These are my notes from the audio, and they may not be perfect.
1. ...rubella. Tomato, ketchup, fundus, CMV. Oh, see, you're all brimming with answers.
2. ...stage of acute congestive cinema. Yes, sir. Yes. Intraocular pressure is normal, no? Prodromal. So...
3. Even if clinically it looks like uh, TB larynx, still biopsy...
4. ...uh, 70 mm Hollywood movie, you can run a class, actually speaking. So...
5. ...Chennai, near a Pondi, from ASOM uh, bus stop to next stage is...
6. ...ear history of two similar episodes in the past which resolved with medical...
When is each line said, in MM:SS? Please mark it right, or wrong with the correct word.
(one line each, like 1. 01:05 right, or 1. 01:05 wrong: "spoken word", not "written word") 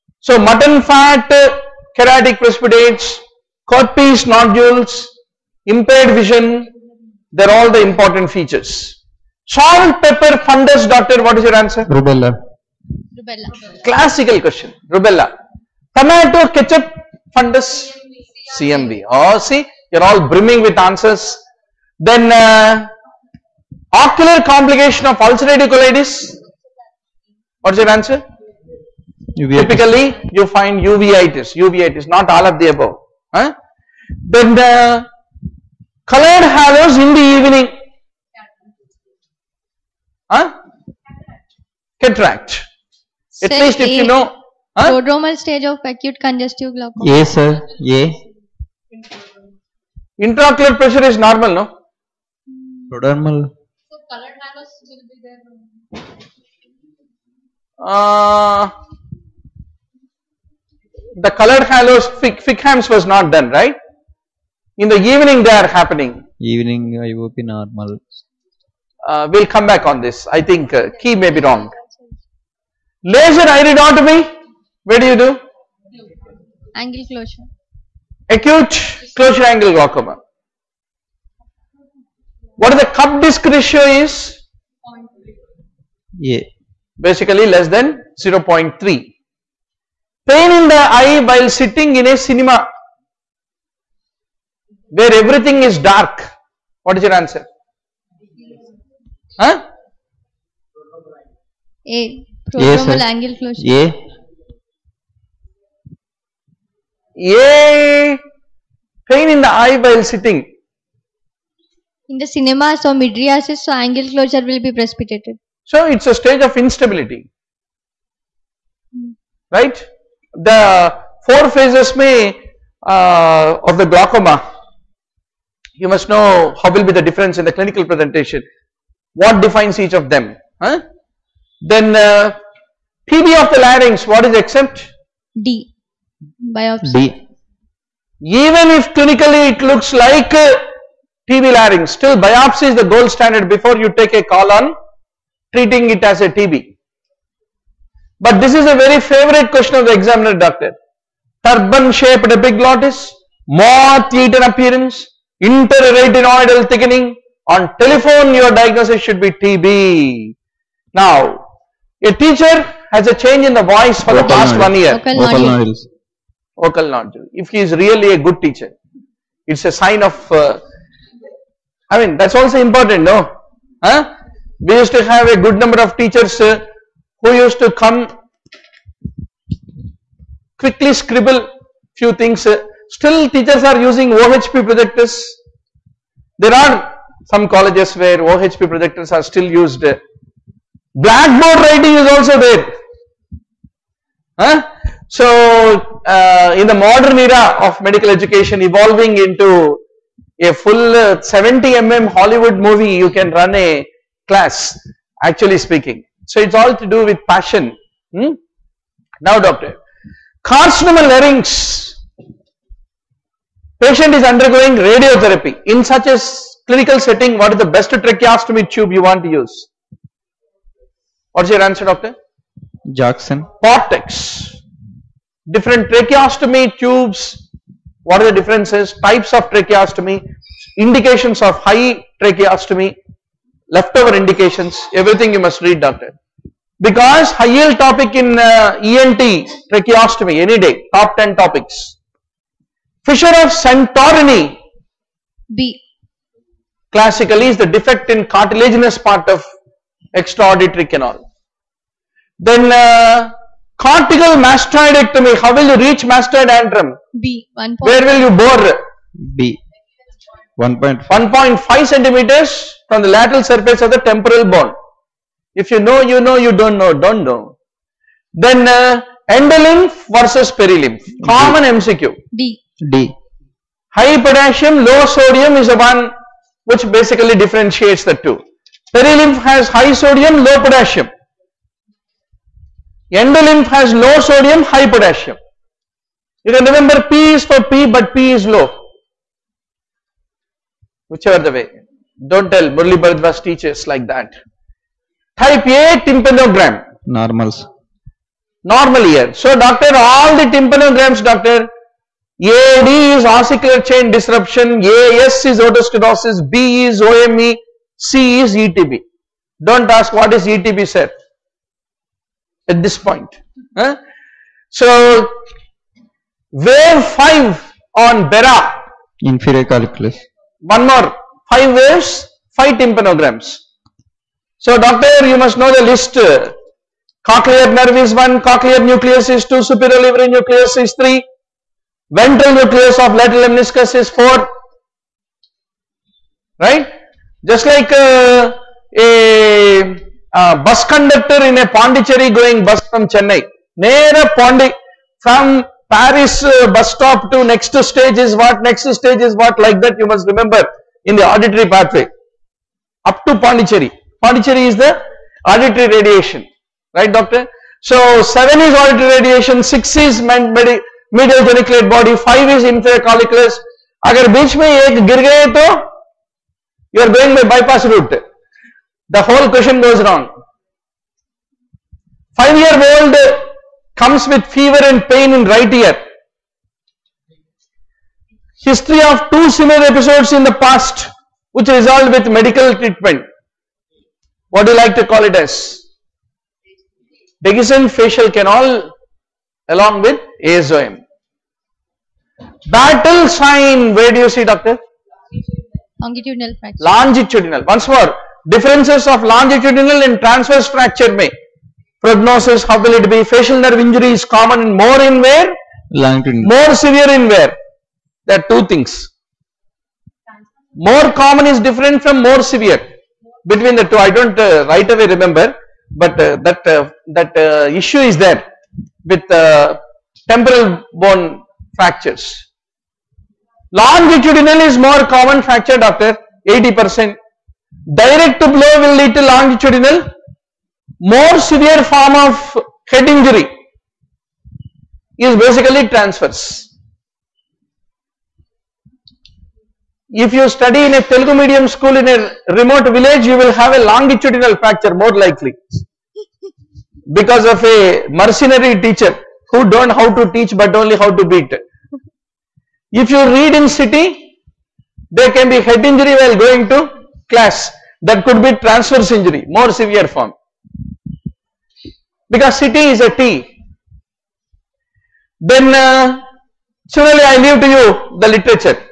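1. 00:14 right
2. 00:45 wrong: "glaucoma", not "cinema"
3. 02:18 right
4. 03:20 right
5. 05:43 wrong: "Paris", not "ASOM"
6. 06:15 right.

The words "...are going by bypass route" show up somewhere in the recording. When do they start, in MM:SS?
06:07.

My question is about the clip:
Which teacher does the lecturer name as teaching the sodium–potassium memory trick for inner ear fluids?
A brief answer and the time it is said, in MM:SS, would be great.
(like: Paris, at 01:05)
Murli Bharadwaj, at 04:52.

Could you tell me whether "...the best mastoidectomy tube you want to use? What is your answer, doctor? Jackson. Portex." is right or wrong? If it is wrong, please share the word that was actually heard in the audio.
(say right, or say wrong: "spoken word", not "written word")
wrong: "tracheostomy", not "mastoidectomy".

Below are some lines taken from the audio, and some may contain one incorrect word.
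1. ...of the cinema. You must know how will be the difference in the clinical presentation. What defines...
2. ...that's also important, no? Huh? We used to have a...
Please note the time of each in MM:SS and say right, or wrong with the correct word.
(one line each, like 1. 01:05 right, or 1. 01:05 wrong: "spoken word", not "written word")
1. 02:03 wrong: "glaucoma", not "cinema"
2. 02:52 right.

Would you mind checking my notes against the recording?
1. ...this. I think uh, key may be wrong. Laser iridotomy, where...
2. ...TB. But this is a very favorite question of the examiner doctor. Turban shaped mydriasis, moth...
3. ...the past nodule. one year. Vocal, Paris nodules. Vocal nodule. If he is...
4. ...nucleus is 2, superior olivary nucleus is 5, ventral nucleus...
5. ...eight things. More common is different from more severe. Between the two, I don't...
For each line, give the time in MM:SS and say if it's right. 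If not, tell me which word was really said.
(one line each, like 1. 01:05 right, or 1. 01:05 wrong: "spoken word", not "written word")
1. 01:09 right
2. 02:26 wrong: "epiglottis", not "mydriasis"
3. 02:44 wrong: "Vocal", not "Paris"
4. 05:28 wrong: "3", not "5"
5. 06:48 wrong: "two", not "eight".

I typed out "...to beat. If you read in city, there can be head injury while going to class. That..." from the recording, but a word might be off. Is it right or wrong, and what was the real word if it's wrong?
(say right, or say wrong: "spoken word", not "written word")
right.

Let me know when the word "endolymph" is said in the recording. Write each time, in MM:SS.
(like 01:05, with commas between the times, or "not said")
04:29, 04:43.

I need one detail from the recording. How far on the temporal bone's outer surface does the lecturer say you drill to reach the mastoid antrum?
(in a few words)
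1.5 centimeters.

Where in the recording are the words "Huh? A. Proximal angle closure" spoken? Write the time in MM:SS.
01:39.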